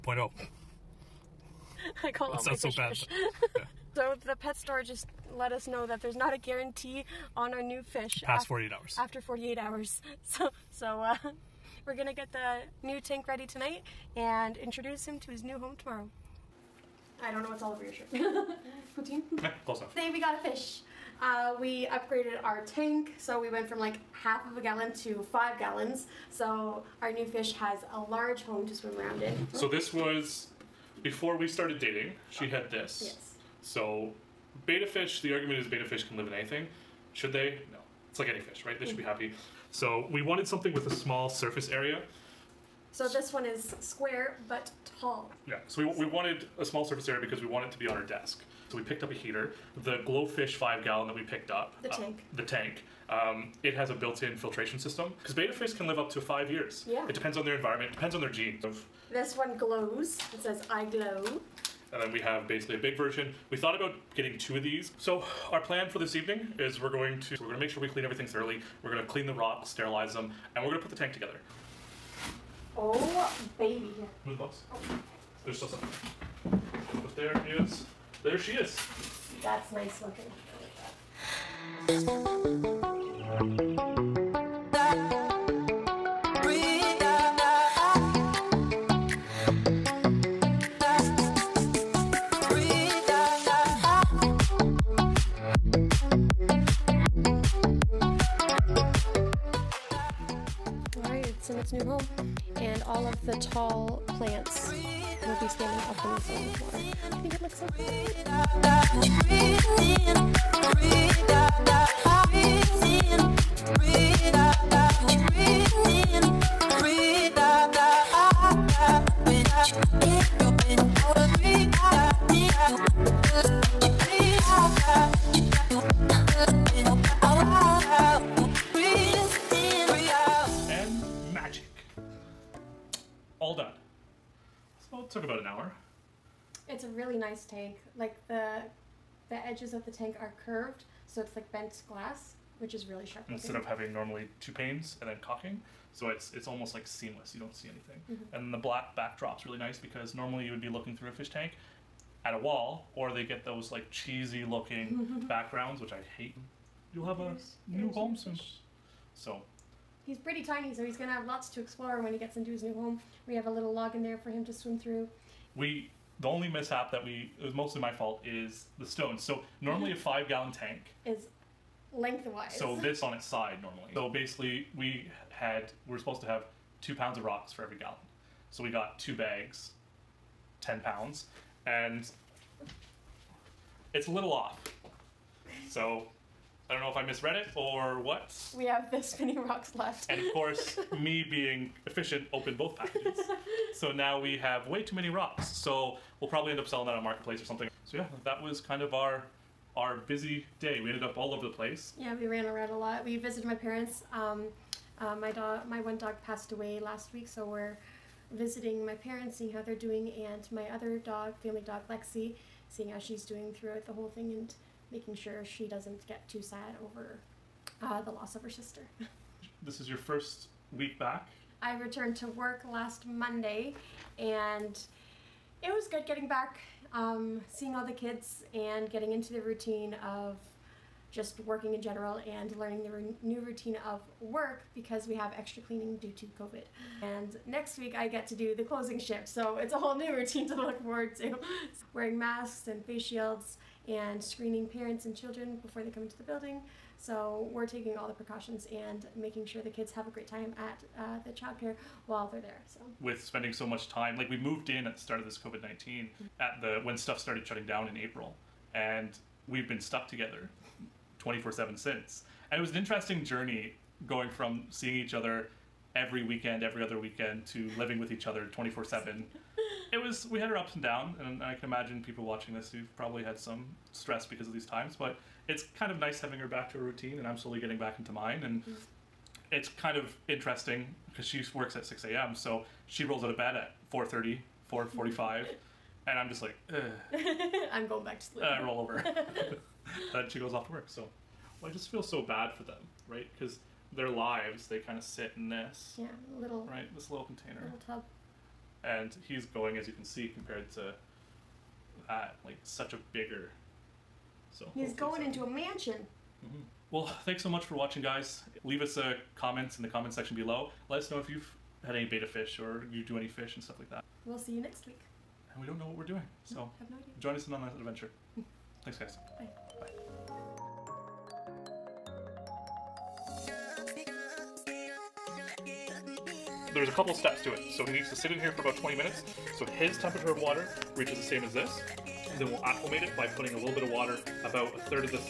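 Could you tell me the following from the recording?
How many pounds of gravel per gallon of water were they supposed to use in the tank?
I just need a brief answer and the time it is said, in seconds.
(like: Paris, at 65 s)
2 pounds, at 176 s.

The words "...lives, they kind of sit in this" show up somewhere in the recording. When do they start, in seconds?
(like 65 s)
294 s.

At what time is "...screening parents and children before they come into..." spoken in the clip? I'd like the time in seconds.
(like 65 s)
244 s.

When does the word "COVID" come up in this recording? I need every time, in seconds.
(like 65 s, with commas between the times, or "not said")
236 s, 255 s.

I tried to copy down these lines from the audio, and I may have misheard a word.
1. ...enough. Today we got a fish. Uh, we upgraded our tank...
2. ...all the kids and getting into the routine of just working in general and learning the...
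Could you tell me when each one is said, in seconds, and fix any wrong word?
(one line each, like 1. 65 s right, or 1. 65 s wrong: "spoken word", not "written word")
1. 19 s right
2. 227 s right.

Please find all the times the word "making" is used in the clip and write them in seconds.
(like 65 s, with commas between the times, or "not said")
214 s, 249 s.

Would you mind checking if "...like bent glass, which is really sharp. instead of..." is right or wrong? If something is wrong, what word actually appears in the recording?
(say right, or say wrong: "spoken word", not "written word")
right.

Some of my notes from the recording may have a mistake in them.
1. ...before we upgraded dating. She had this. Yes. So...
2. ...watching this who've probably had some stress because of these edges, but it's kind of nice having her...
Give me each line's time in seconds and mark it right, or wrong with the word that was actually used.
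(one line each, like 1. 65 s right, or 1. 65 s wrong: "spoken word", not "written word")
1. 31 s wrong: "started", not "upgraded"
2. 272 s wrong: "times", not "edges".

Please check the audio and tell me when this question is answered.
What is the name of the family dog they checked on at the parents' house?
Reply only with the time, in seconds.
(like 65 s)
211 s.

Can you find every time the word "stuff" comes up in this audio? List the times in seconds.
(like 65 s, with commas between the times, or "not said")
256 s, 313 s.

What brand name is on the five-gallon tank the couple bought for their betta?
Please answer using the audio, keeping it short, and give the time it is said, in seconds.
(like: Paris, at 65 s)
GloFish, at 50 s.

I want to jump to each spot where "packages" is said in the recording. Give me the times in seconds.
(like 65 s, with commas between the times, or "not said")
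192 s.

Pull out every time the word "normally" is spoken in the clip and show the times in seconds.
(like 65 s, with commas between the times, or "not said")
143 s, 150 s, 169 s, 173 s.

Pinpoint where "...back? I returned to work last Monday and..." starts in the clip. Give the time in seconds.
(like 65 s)
220 s.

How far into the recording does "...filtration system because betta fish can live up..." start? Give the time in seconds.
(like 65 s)
54 s.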